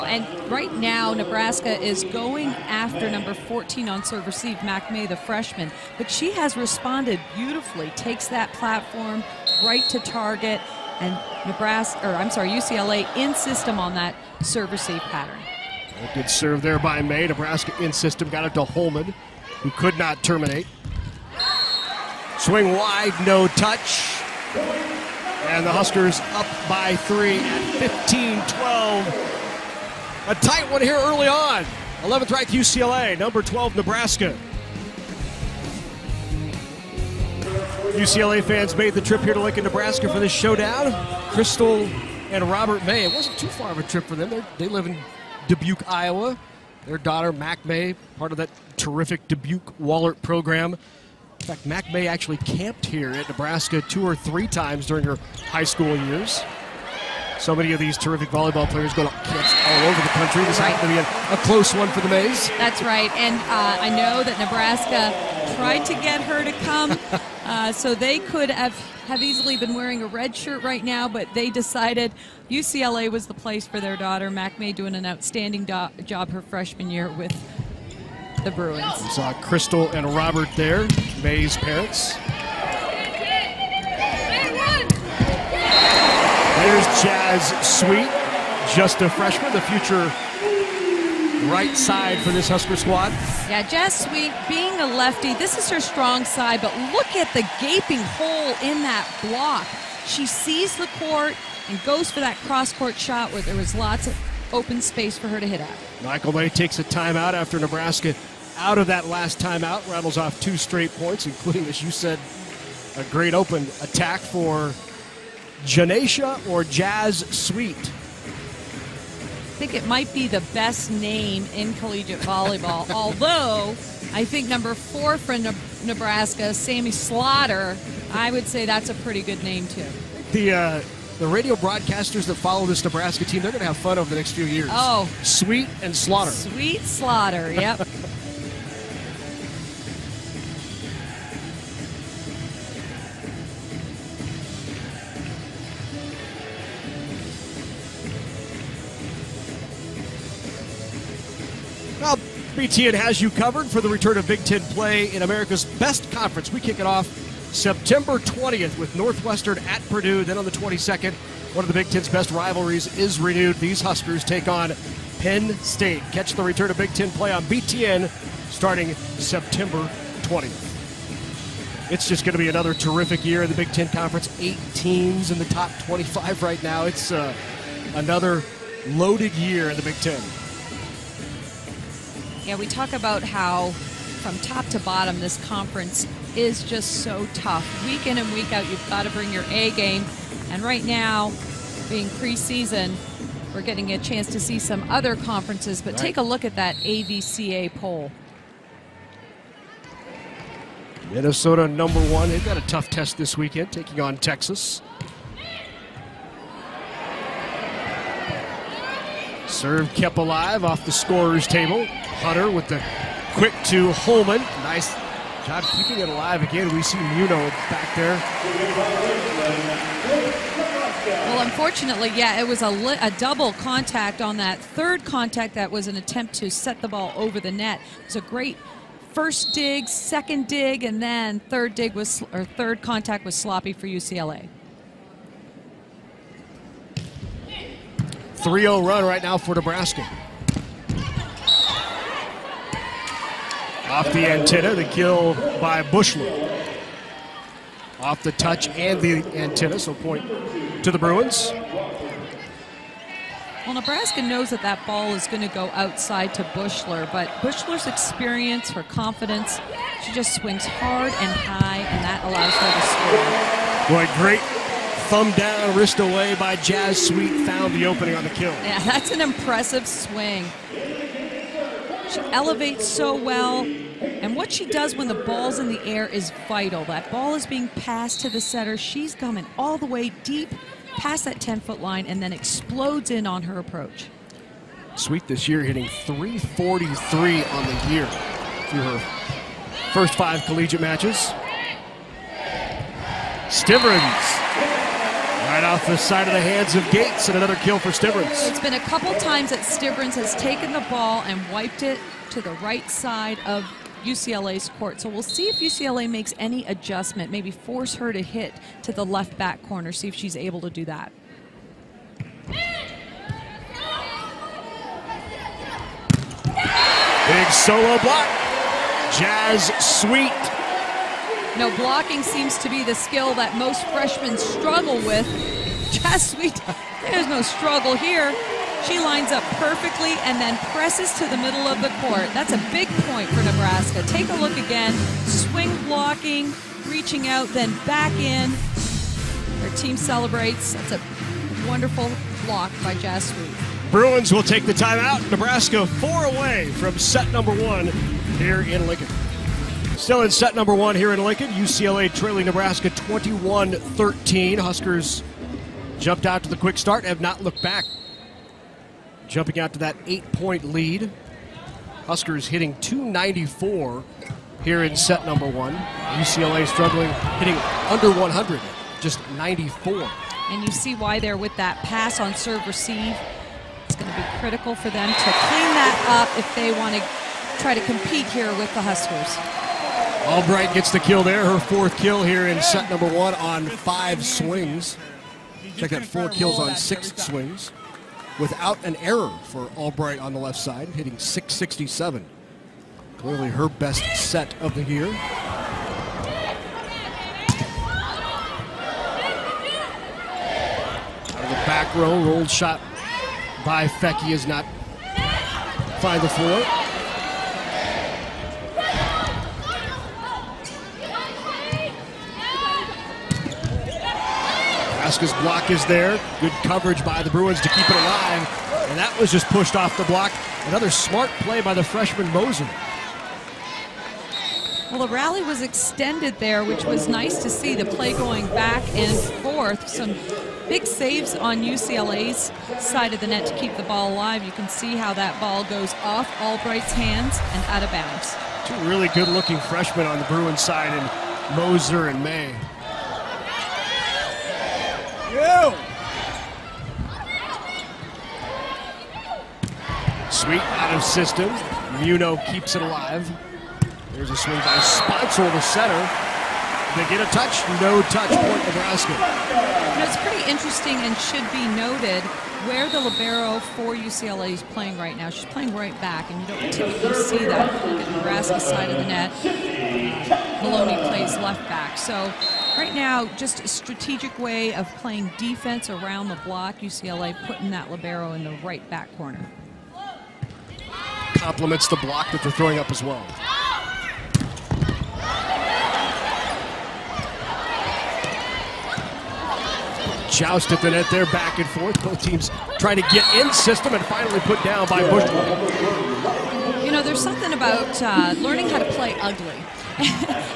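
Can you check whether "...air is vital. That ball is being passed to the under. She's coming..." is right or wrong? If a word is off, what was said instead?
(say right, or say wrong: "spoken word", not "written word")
wrong: "setter", not "under".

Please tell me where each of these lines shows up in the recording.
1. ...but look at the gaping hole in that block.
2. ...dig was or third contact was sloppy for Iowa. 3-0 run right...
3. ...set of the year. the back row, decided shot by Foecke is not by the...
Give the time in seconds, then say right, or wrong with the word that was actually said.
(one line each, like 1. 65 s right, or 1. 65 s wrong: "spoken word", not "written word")
1. 96 s right
2. 231 s wrong: "UCLA", not "Iowa"
3. 394 s wrong: "rolled", not "decided".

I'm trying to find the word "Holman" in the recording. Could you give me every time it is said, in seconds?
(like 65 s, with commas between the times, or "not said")
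18 s, 213 s.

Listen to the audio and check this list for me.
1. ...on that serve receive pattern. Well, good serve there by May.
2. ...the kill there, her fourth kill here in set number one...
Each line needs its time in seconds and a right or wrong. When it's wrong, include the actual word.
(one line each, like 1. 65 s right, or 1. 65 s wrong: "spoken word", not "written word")
1. 13 s right
2. 380 s right.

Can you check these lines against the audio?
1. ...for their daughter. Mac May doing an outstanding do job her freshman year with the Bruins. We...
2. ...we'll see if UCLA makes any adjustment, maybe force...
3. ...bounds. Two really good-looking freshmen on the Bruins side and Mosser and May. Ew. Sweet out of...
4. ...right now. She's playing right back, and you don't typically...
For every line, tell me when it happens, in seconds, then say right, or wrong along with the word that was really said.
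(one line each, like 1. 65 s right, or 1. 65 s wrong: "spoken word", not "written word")
1. 73 s right
2. 305 s right
3. 437 s right
4. 464 s right.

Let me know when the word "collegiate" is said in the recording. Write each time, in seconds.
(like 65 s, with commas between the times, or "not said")
121 s, 290 s.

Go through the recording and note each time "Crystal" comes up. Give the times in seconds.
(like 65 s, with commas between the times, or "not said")
41 s, 79 s.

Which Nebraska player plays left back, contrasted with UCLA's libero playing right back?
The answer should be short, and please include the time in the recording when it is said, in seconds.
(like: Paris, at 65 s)
Maloney, at 470 s.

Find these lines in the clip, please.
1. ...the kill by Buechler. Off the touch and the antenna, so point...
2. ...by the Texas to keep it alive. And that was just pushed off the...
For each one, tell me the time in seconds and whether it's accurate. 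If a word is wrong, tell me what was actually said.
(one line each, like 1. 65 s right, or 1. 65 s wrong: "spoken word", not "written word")
1. 244 s right
2. 417 s wrong: "Bruins", not "Texas".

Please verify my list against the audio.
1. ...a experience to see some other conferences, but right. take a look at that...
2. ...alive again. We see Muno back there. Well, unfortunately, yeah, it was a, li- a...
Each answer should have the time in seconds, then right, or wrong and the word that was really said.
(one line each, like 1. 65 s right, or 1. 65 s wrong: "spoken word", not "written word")
1. 193 s wrong: "chance", not "experience"
2. 216 s right.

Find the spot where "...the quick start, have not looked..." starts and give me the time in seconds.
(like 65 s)
356 s.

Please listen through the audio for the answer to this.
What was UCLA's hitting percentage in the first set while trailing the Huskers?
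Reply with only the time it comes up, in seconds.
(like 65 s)
369 s.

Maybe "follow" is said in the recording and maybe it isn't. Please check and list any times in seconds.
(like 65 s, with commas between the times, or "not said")
132 s.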